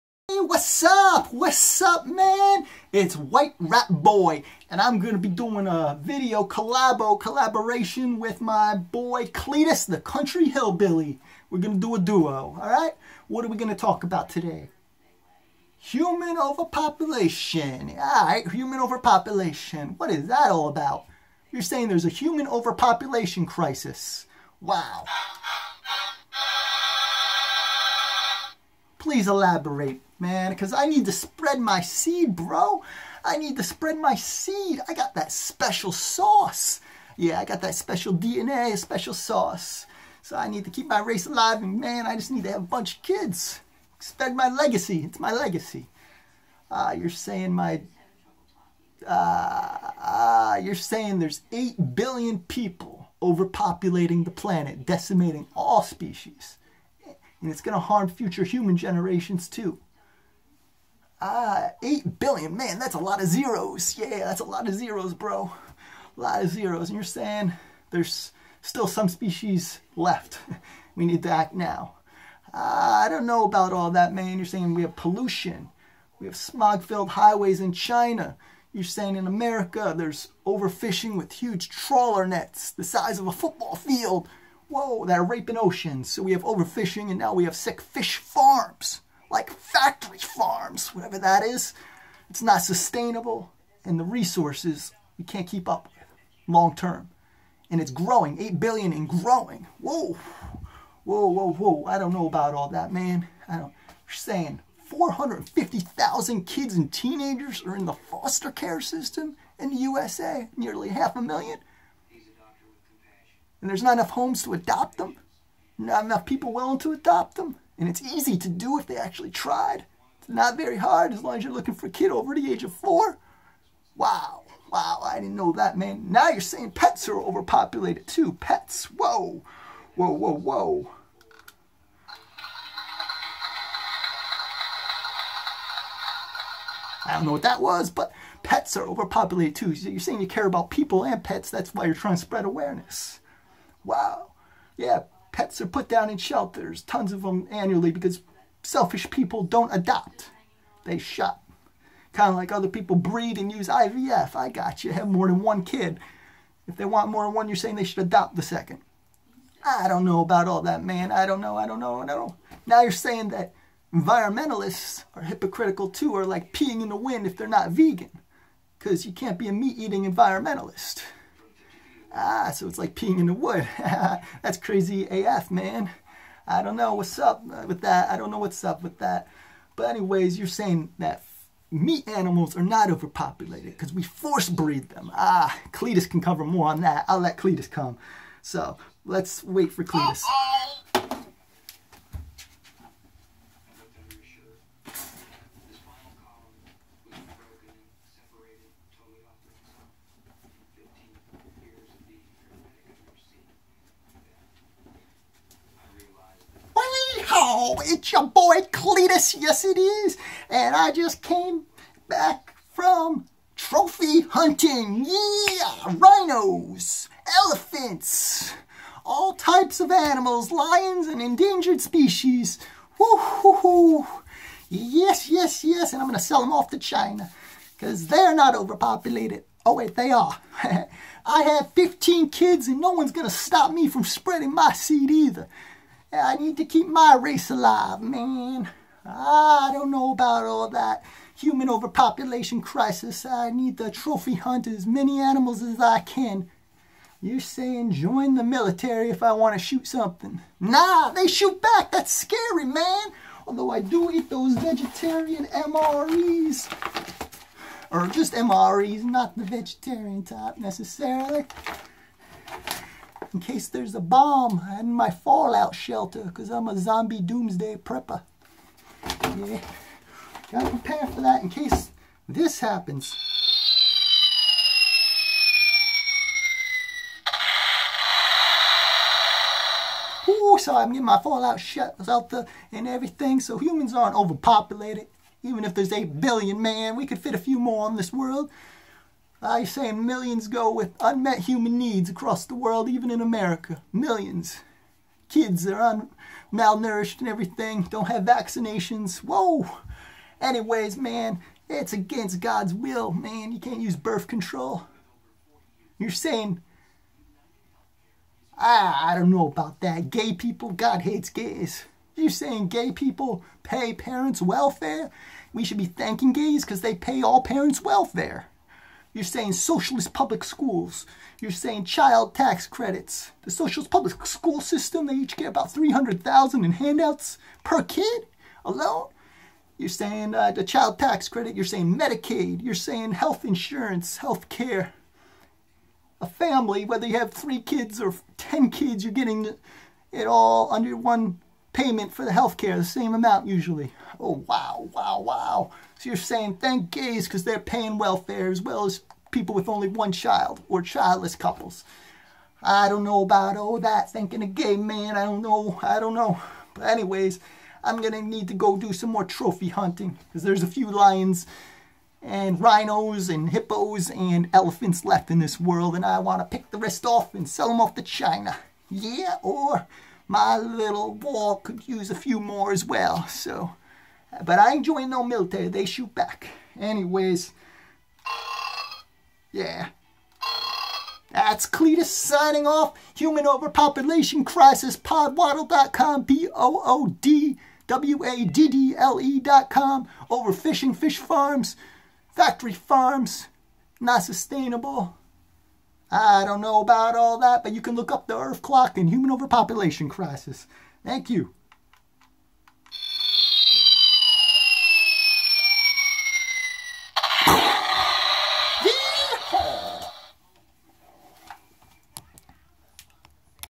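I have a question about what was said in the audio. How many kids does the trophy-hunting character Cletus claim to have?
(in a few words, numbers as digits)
15.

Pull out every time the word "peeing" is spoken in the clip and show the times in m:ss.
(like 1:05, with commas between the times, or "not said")
2:46, 2:52.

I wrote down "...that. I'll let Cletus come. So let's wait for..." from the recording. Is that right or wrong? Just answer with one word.
right.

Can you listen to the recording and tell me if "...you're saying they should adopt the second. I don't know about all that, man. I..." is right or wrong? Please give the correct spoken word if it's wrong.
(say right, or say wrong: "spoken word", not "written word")
right.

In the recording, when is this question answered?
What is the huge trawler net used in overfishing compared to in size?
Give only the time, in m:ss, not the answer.
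1:22.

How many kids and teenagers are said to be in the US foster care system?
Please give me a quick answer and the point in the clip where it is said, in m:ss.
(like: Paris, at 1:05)
450,000, at 1:44.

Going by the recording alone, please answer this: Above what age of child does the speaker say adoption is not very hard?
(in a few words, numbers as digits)
4.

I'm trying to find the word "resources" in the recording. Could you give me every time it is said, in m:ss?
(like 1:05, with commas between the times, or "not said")
1:34.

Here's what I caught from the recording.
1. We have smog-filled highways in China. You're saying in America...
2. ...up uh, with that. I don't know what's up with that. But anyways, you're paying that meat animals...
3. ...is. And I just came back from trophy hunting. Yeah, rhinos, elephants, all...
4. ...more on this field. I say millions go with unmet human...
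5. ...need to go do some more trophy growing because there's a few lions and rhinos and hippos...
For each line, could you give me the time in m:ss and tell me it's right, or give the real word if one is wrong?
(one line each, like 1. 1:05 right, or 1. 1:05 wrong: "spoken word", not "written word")
1. 1:16 right
2. 2:57 wrong: "saying", not "paying"
3. 3:29 right
4. 4:47 wrong: "world", not "field"
5. 5:58 wrong: "hunting", not "growing".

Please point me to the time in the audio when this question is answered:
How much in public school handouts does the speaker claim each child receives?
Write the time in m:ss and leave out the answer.
5:25.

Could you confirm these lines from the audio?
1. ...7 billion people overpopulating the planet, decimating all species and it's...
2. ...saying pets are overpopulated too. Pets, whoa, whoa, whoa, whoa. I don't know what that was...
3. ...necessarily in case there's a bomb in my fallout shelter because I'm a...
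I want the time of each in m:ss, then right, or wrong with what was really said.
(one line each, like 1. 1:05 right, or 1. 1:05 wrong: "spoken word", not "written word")
1. 0:51 wrong: "8", not "7"
2. 2:06 right
3. 4:20 right.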